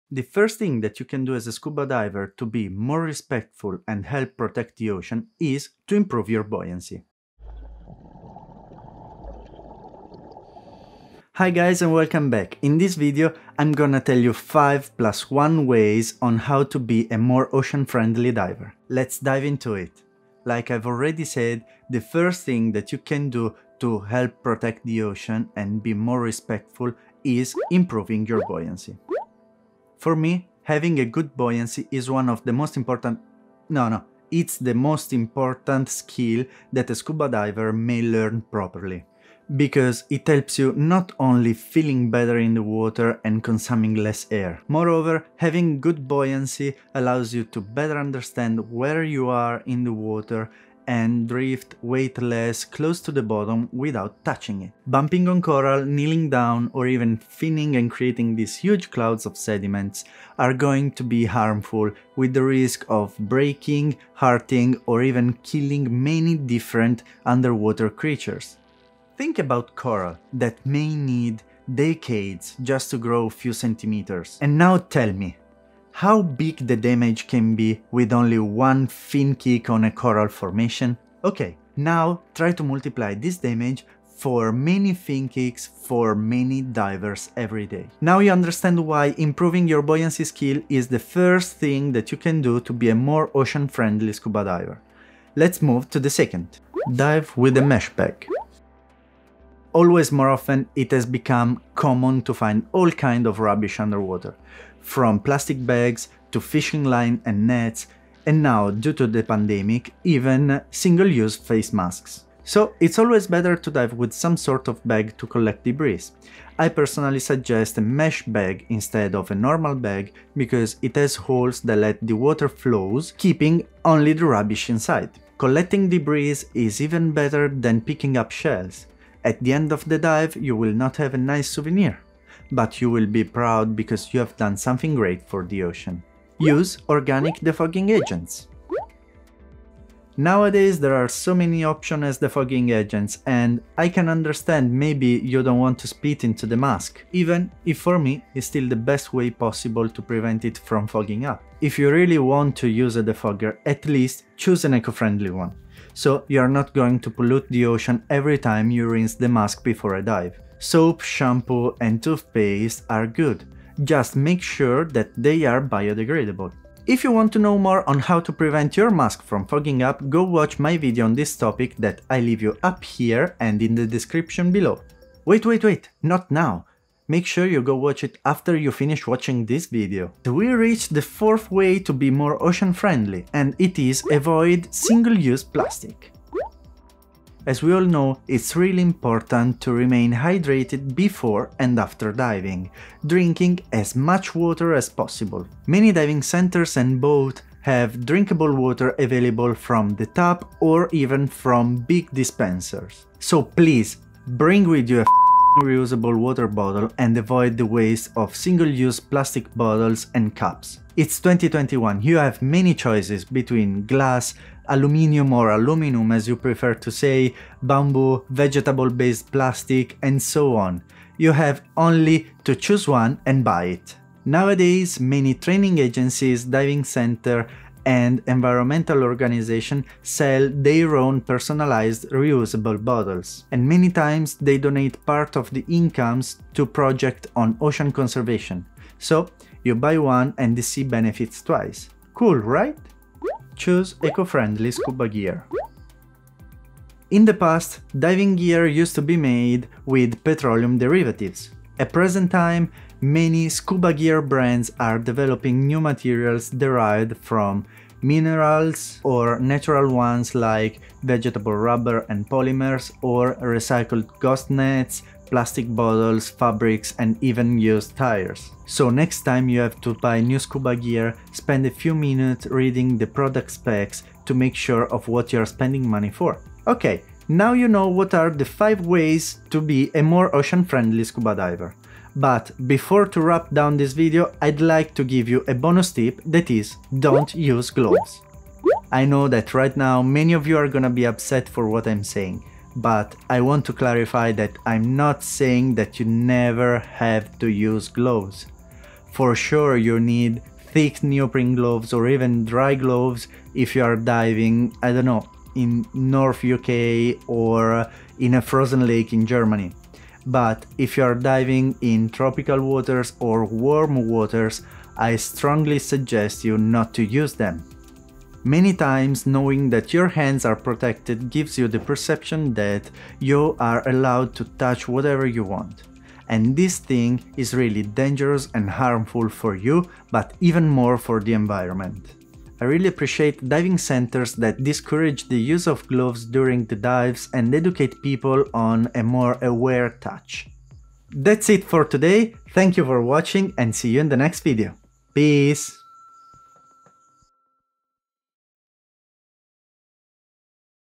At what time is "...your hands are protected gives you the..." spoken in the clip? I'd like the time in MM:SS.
05:19.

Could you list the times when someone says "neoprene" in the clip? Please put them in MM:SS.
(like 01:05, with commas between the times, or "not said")
05:01.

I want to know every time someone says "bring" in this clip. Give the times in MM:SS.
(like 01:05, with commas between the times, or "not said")
03:24.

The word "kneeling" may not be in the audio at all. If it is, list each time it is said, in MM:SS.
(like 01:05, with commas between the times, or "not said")
00:55.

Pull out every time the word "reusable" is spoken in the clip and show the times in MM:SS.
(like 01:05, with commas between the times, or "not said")
03:25, 03:52.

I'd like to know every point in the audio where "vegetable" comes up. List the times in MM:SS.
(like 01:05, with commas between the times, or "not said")
03:38, 04:21.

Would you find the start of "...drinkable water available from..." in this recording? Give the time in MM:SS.
03:18.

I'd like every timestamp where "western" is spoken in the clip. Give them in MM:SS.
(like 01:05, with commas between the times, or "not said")
not said.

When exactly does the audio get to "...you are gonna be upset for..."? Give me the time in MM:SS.
04:50.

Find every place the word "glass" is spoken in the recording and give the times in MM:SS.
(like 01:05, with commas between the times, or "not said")
03:33.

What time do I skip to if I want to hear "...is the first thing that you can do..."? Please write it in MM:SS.
01:30.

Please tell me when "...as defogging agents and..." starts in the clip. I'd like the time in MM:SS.
02:22.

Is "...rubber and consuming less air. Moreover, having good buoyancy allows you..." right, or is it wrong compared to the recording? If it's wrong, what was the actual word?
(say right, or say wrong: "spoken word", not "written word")
wrong: "water", not "rubber".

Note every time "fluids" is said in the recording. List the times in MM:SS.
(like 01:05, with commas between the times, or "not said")
not said.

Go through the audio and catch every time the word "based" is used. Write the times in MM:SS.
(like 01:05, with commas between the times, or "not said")
03:38.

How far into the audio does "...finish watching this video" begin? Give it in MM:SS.
02:58.